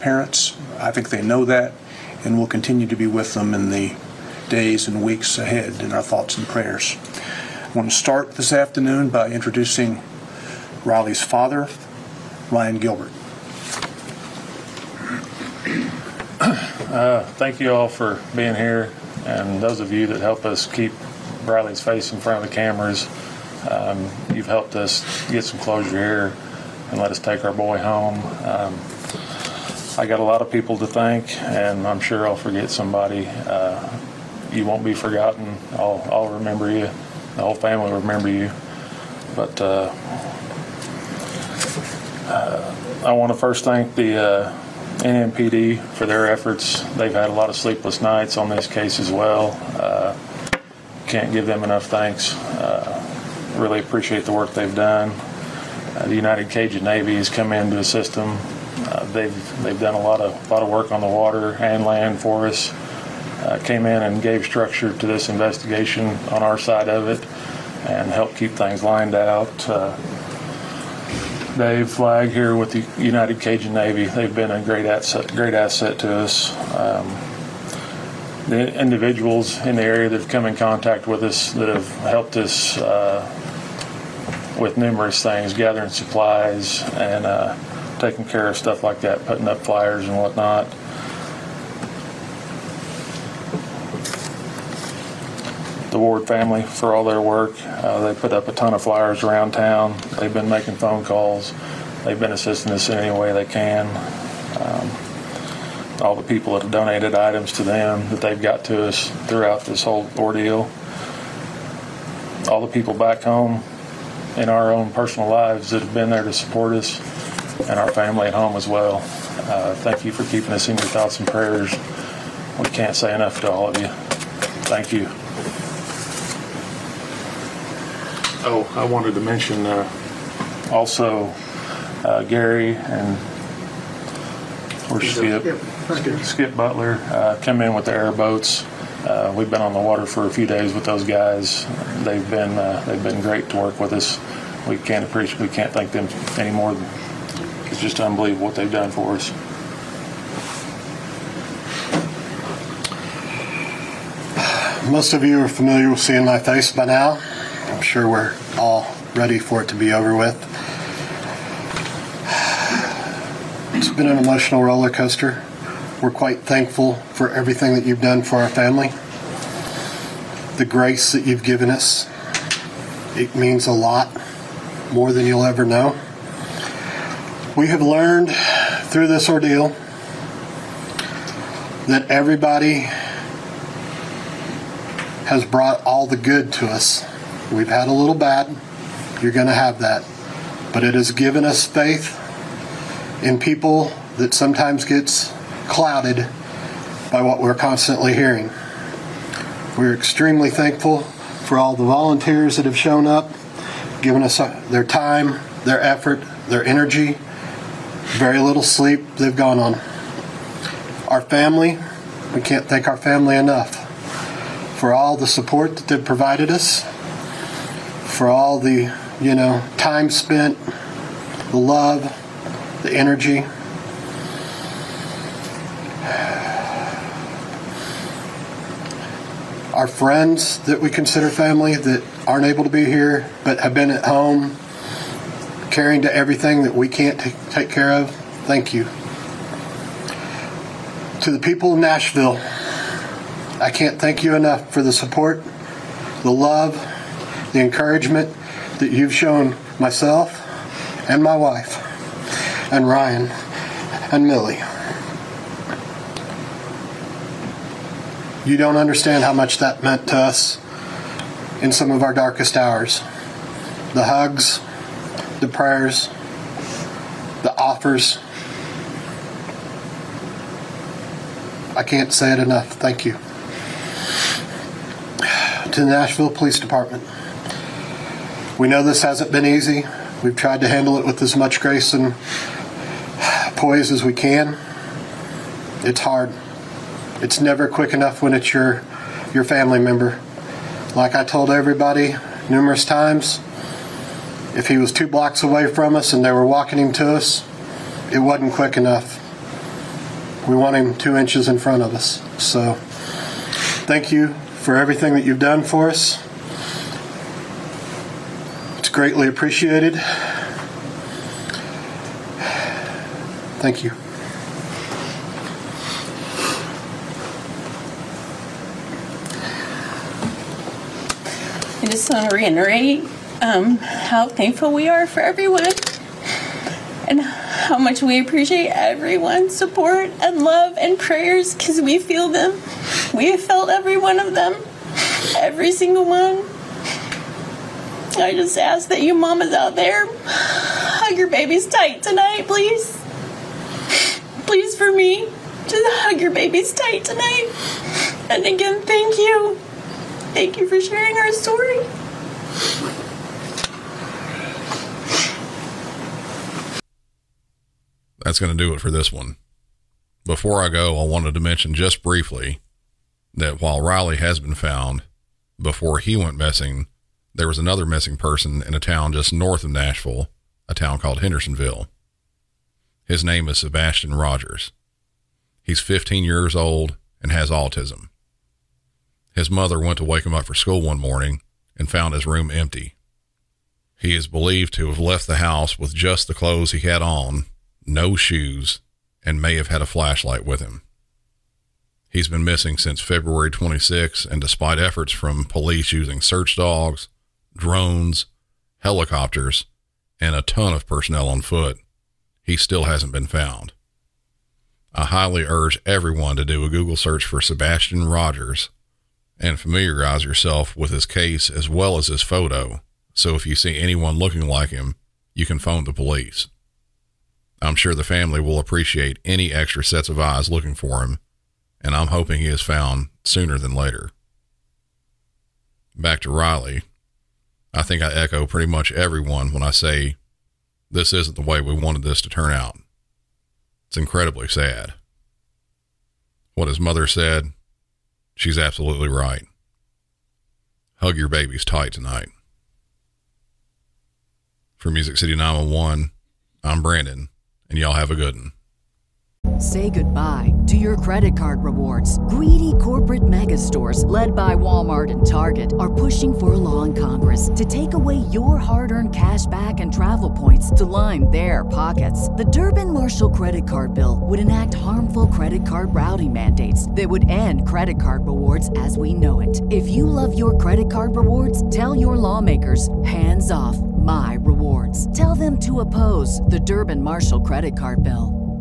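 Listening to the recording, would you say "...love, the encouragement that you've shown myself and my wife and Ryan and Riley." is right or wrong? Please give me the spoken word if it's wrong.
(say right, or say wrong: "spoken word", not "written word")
wrong: "Millie", not "Riley".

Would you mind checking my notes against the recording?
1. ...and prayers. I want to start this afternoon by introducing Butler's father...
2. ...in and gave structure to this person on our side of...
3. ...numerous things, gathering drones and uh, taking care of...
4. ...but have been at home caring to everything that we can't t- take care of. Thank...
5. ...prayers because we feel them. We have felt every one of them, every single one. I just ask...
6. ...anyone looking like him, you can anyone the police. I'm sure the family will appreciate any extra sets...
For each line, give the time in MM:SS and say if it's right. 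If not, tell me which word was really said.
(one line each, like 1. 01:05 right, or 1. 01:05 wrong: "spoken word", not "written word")
1. 00:06 wrong: "Riley", not "Butler"
2. 01:03 wrong: "investigation", not "person"
3. 01:24 wrong: "supplies", not "drones"
4. 03:53 right
5. 05:30 right
6. 06:53 wrong: "phone", not "anyone".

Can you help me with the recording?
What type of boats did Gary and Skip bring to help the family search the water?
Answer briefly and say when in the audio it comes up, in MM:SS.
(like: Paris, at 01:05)
Airboats, at 02:17.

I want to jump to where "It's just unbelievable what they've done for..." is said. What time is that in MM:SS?
02:27.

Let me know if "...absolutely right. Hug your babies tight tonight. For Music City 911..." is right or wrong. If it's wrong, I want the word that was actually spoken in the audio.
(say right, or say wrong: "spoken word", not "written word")
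right.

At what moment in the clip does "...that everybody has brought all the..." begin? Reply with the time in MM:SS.
03:01.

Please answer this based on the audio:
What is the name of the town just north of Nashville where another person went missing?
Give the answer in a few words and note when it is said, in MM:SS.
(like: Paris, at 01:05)
Hendersonville, at 06:11.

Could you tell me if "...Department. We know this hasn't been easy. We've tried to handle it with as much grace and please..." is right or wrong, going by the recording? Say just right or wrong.
wrong.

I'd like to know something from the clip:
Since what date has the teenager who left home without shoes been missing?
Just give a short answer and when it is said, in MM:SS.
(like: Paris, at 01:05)
February 26, at 06:33.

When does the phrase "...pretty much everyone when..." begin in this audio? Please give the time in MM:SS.
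07:08.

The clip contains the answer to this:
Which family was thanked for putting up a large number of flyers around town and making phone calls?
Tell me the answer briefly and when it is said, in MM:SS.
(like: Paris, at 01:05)
The Ward family, at 01:35.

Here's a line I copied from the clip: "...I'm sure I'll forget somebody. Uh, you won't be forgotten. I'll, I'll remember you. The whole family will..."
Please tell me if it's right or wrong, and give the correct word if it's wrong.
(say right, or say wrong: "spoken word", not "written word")
right.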